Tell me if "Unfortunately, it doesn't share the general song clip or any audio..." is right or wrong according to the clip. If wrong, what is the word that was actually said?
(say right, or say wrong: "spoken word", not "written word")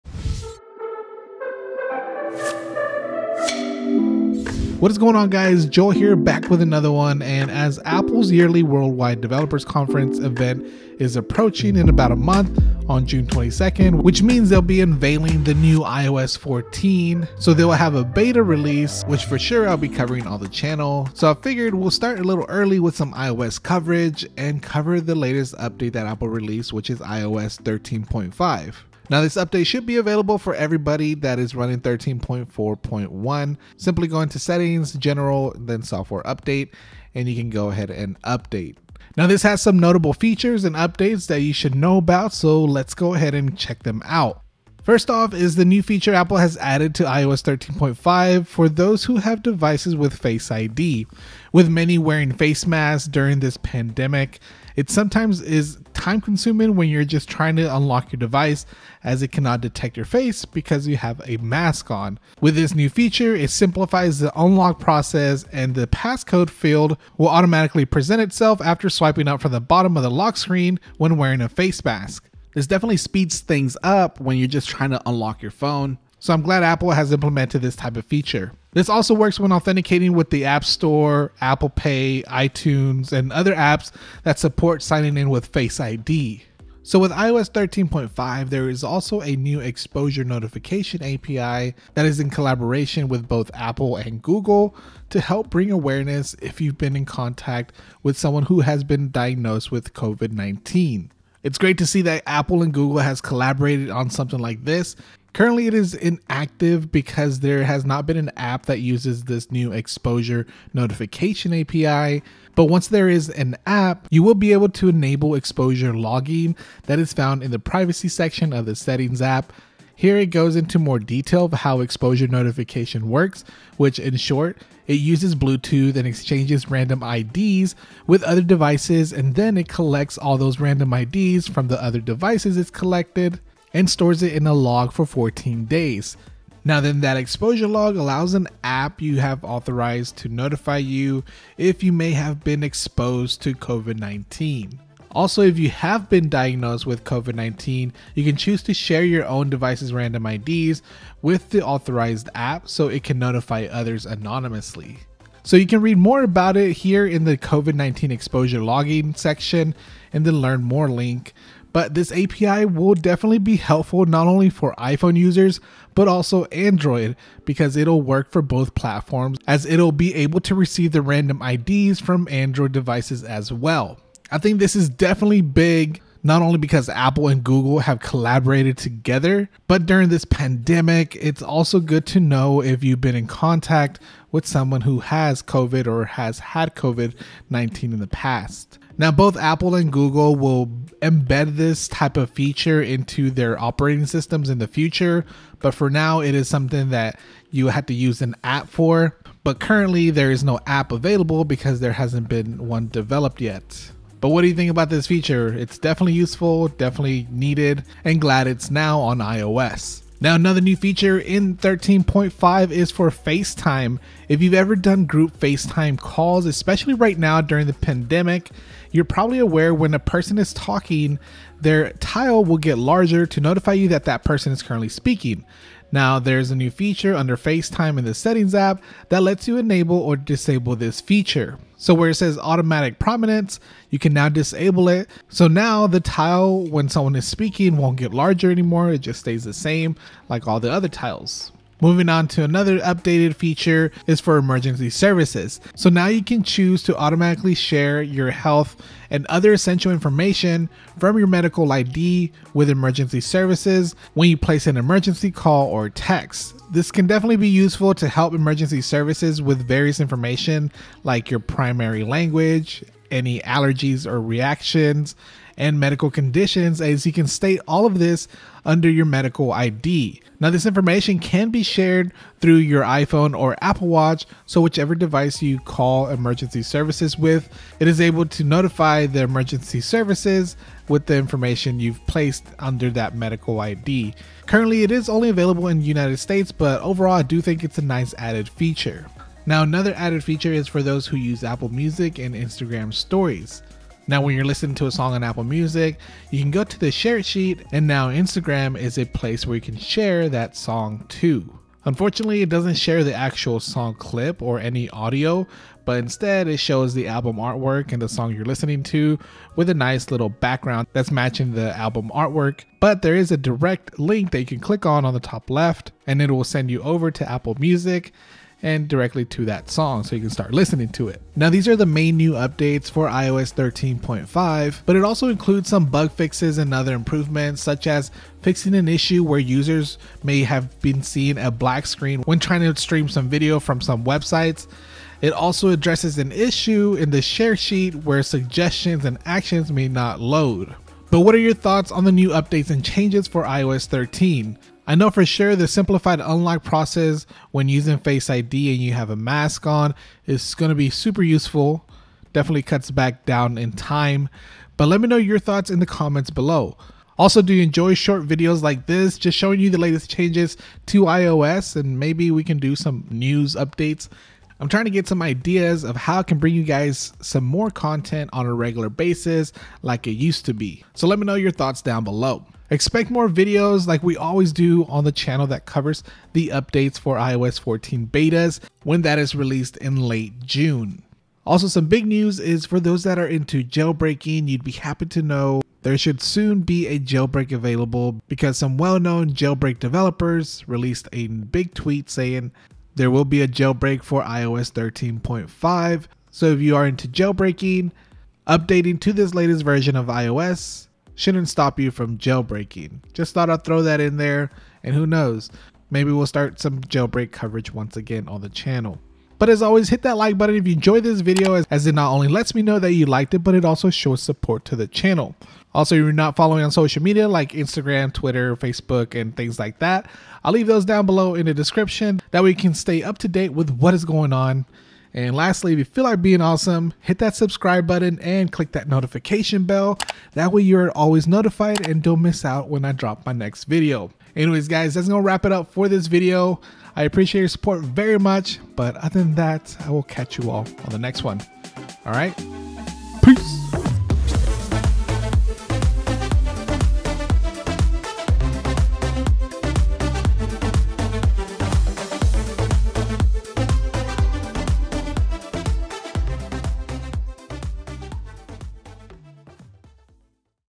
wrong: "actual", not "general".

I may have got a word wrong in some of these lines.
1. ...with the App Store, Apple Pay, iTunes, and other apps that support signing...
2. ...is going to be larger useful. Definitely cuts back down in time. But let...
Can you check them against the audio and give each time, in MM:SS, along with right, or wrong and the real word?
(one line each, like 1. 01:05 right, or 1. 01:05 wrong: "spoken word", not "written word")
1. 01:20 right
2. 05:50 wrong: "super", not "larger".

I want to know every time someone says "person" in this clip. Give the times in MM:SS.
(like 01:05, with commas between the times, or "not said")
03:39, 03:44.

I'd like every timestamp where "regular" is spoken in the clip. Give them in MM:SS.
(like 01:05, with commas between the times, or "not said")
06:08.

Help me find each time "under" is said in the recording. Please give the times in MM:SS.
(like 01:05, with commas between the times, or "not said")
03:47, 04:28, 04:42.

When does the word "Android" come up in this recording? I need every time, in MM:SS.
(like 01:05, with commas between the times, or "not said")
02:46, 02:52.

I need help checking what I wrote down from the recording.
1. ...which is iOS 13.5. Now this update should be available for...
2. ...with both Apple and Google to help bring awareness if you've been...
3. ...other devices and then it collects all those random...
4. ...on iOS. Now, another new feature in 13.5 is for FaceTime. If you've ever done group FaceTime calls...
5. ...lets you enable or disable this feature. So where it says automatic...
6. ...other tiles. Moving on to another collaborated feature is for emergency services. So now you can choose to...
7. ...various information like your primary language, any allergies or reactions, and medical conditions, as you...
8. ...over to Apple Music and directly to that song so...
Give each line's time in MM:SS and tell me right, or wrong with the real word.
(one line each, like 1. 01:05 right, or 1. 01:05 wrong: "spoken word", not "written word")
1. 00:26 right
2. 01:33 right
3. 02:08 right
4. 03:28 right
5. 03:49 right
6. 04:00 wrong: "updated", not "collaborated"
7. 04:19 right
8. 05:16 right.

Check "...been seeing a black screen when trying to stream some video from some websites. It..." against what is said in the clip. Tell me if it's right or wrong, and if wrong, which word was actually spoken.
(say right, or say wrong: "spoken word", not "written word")
right.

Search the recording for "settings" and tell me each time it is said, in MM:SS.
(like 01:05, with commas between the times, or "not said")
00:34, 01:58, 03:48.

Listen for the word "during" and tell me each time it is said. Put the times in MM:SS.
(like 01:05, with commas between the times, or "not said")
00:53, 02:59, 03:37.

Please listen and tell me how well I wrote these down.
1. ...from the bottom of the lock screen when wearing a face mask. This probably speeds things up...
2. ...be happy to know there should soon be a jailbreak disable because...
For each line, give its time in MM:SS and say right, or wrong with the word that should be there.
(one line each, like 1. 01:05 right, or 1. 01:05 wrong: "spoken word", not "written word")
1. 01:09 wrong: "definitely", not "probably"
2. 06:24 wrong: "available", not "disable".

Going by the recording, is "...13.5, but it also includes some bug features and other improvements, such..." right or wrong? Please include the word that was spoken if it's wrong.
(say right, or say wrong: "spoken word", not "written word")
wrong: "fixes", not "features".